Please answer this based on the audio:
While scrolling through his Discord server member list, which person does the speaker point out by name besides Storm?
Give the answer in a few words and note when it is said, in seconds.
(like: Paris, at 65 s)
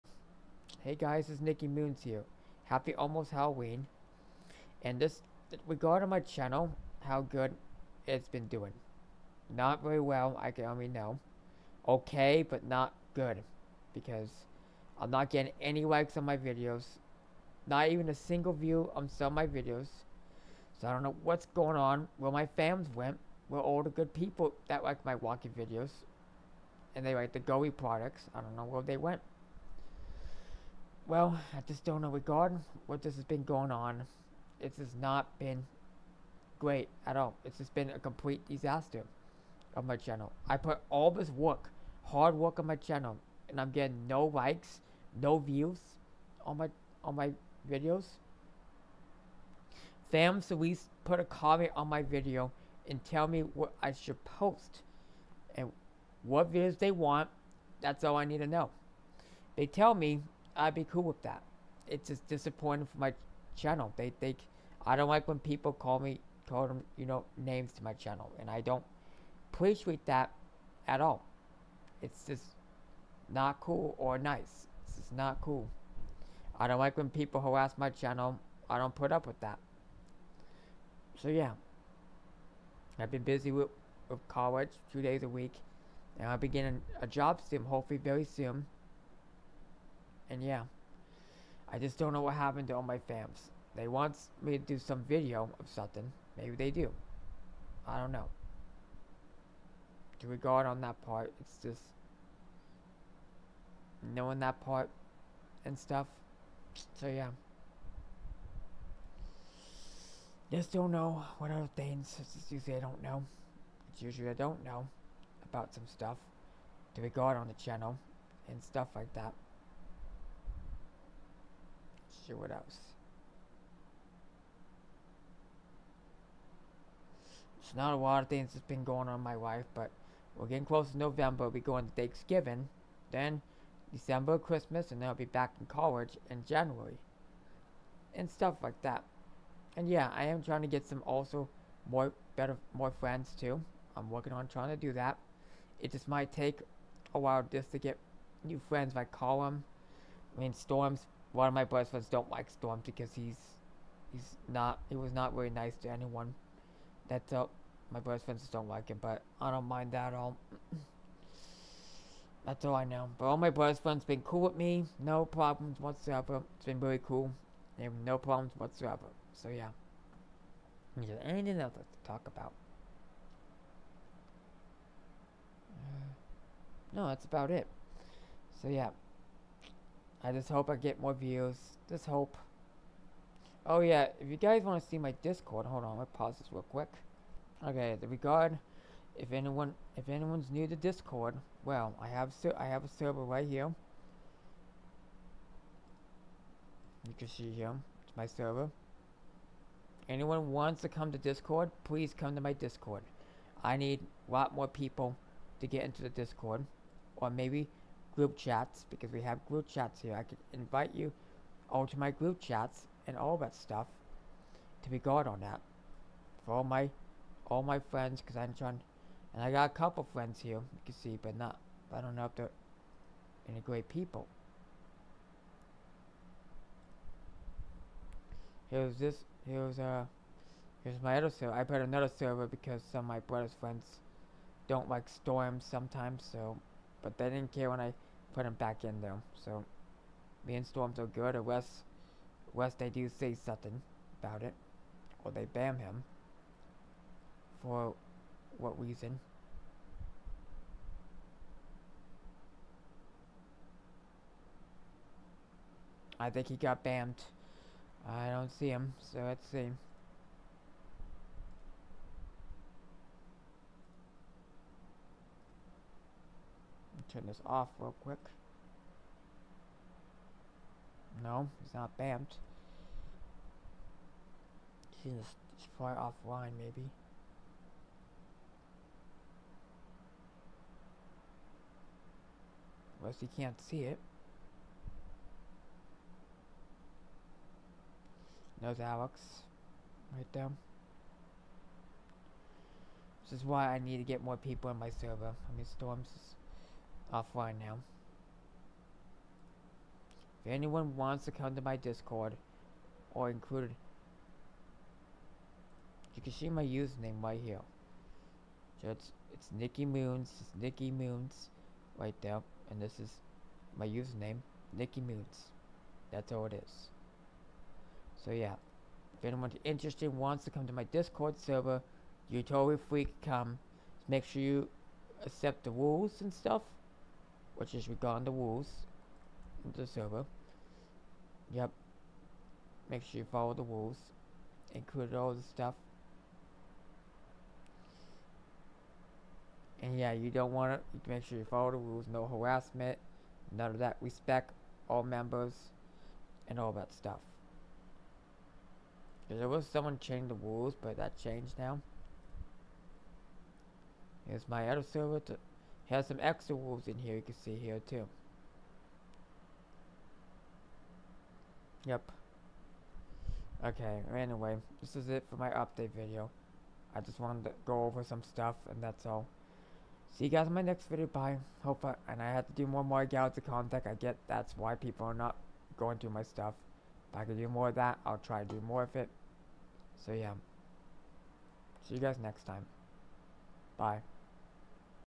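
Alex, at 288 s.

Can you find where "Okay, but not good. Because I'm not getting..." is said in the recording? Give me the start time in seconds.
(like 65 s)
11 s.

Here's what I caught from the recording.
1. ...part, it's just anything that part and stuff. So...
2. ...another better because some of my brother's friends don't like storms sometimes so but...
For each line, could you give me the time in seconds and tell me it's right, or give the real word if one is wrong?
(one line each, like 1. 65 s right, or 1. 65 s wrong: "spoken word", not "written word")
1. 101 s wrong: "knowing", not "anything"
2. 231 s wrong: "server", not "better".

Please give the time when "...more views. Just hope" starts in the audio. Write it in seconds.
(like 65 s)
180 s.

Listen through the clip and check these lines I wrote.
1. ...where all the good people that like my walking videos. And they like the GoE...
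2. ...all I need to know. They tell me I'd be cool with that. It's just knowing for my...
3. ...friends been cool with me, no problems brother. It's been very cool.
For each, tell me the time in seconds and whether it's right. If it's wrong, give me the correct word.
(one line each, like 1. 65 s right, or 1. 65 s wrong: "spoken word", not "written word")
1. 23 s right
2. 58 s wrong: "disappointing", not "knowing"
3. 163 s wrong: "whatsoever", not "brother".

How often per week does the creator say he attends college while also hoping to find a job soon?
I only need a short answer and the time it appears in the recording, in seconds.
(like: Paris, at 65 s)
2 days a week, at 84 s.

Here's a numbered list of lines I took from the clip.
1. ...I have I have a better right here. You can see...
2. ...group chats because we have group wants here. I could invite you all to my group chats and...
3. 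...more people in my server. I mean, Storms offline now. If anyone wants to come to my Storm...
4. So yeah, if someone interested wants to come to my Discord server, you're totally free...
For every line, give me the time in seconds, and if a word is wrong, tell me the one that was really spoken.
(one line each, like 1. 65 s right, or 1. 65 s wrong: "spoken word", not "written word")
1. 192 s wrong: "server", not "better"
2. 208 s wrong: "chats", not "wants"
3. 294 s wrong: "Discord", not "Storm"
4. 318 s wrong: "anyone", not "someone".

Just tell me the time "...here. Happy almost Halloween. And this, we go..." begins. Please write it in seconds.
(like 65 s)
2 s.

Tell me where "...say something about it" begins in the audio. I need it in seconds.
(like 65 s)
243 s.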